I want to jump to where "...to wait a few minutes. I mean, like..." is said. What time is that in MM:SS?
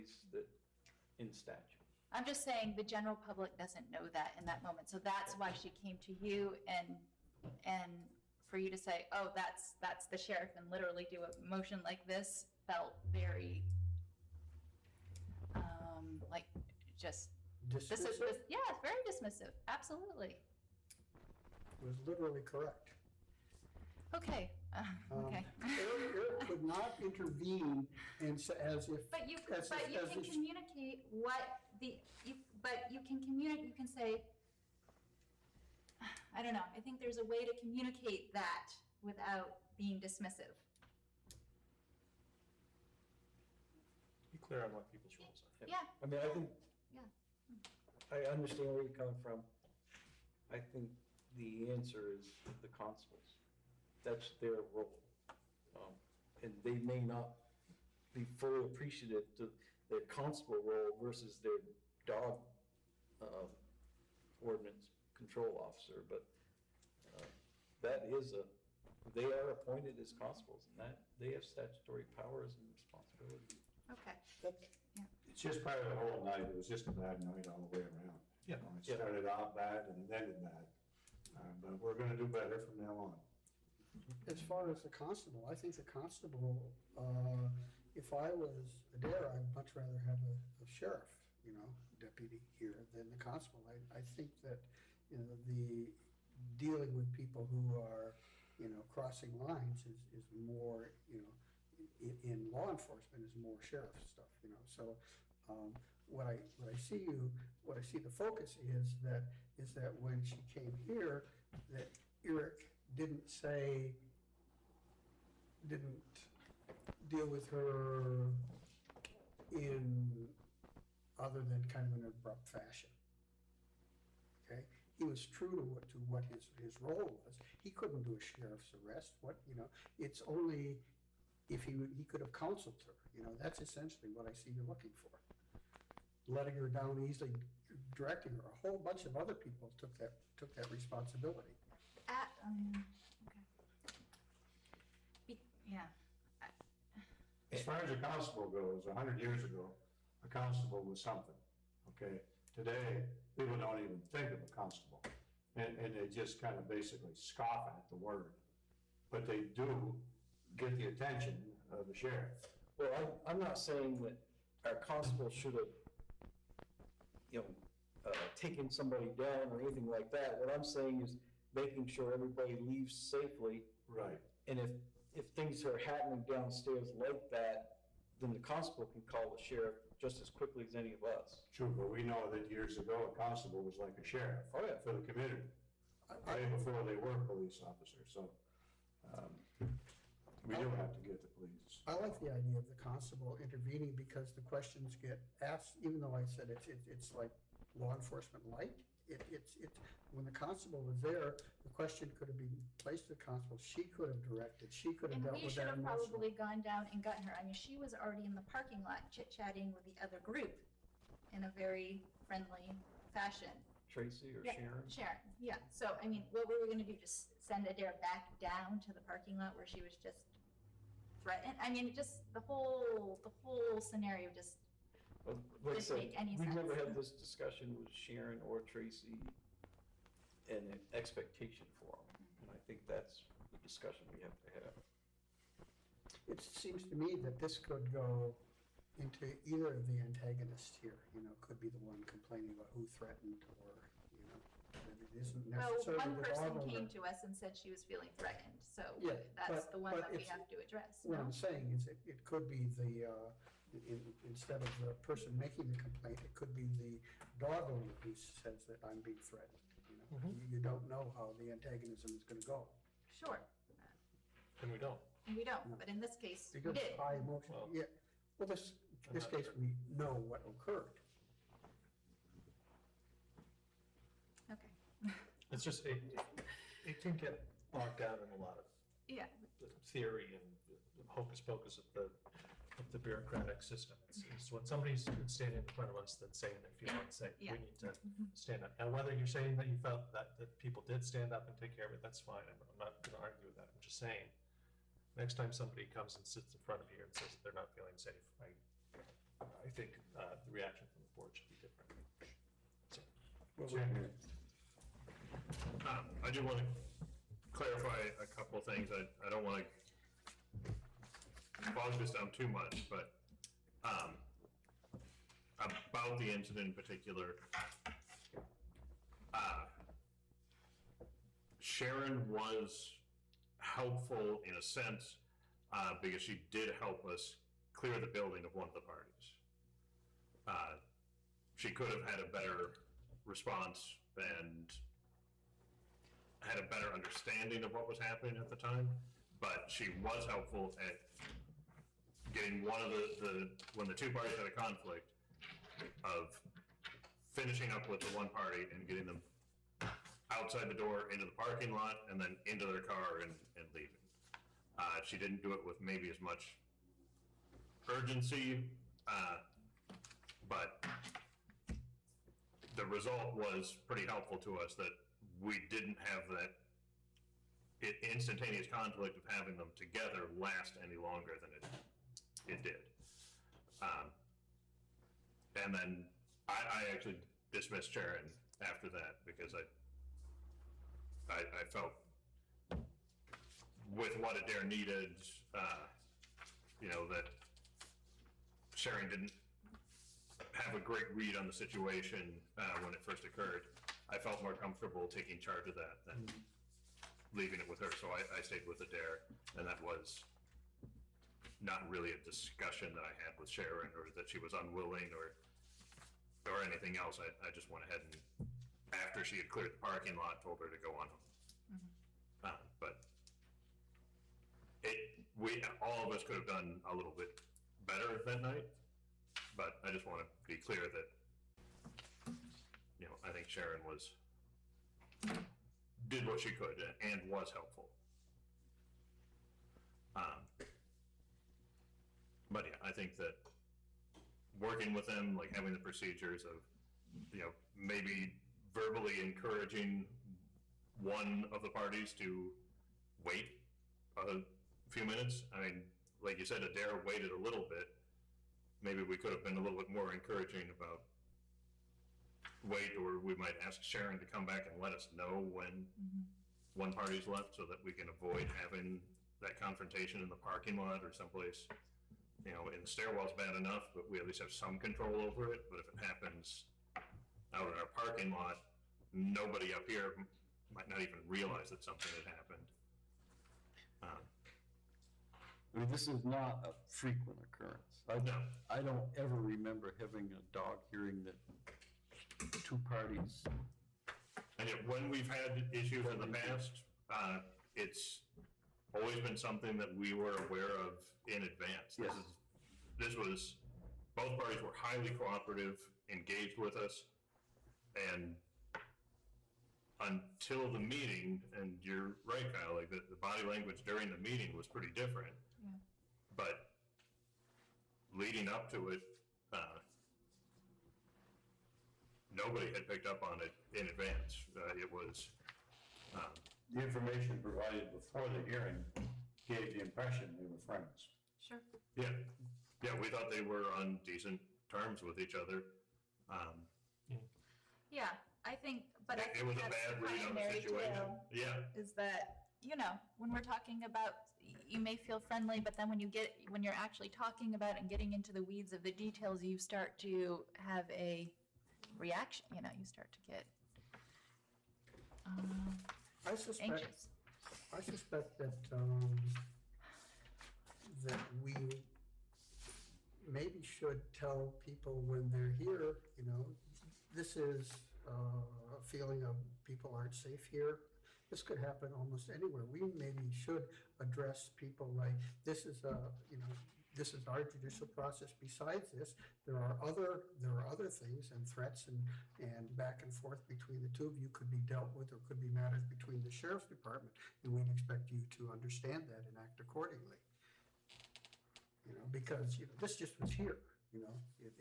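07:22.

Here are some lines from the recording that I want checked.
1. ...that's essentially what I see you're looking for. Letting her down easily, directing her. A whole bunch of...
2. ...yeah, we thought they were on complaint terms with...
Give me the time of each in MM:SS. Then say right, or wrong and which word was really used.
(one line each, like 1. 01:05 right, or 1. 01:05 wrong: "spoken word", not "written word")
1. 02:13 right
2. 08:42 wrong: "decent", not "complaint".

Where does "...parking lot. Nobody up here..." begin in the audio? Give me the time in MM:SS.
07:47.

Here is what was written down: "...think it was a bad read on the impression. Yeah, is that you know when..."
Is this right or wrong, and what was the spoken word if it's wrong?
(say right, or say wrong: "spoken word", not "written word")
wrong: "situation", not "impression".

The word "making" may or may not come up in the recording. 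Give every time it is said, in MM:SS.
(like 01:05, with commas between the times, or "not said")
02:51, 04:15.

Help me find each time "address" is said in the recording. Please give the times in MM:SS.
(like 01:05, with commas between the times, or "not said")
04:10, 09:23.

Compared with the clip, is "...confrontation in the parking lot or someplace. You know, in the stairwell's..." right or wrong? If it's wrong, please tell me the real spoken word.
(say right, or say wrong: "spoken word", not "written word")
right.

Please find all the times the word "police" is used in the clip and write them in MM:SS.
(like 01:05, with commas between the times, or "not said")
03:07, 03:11.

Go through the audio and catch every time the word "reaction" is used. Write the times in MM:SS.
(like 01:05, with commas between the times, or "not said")
05:00, 09:01.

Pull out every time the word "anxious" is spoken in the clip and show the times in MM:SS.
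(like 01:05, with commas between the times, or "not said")
09:06.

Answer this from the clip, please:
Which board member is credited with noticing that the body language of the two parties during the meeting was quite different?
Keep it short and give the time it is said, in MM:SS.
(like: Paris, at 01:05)
Kyle, at 08:22.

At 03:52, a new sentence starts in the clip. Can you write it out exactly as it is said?
And I think that's the discussion we have to have.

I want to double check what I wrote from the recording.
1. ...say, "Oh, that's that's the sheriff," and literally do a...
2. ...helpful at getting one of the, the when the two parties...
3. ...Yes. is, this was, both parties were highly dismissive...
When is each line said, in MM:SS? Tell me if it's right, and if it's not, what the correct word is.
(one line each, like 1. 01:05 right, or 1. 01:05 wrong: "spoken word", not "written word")
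1. 00:08 right
2. 05:40 right
3. 08:12 wrong: "cooperative", not "dismissive".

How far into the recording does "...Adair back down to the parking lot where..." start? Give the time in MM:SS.
03:37.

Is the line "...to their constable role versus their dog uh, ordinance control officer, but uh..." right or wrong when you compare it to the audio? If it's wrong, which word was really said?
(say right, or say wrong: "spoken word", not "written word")
right.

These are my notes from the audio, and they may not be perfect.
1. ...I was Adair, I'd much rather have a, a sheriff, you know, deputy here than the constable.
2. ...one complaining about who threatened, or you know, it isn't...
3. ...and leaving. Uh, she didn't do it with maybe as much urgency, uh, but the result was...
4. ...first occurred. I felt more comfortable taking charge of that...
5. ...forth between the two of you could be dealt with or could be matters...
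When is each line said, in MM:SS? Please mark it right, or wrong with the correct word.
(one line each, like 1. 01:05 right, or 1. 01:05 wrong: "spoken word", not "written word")
1. 01:28 right
2. 04:01 right
3. 05:53 right
4. 06:33 right
5. 09:33 right.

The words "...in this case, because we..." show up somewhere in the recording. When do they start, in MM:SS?
04:25.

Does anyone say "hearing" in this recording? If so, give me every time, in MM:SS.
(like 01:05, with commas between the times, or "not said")
08:00, 08:38.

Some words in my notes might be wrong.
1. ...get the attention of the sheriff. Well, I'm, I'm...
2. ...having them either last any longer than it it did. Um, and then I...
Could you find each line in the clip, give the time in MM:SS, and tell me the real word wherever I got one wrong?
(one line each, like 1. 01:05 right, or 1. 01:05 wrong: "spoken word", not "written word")
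1. 02:40 right
2. 06:09 wrong: "together", not "either".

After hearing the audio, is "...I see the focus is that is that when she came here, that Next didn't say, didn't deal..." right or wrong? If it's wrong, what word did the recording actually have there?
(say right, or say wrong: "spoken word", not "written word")
wrong: "Eric", not "Next".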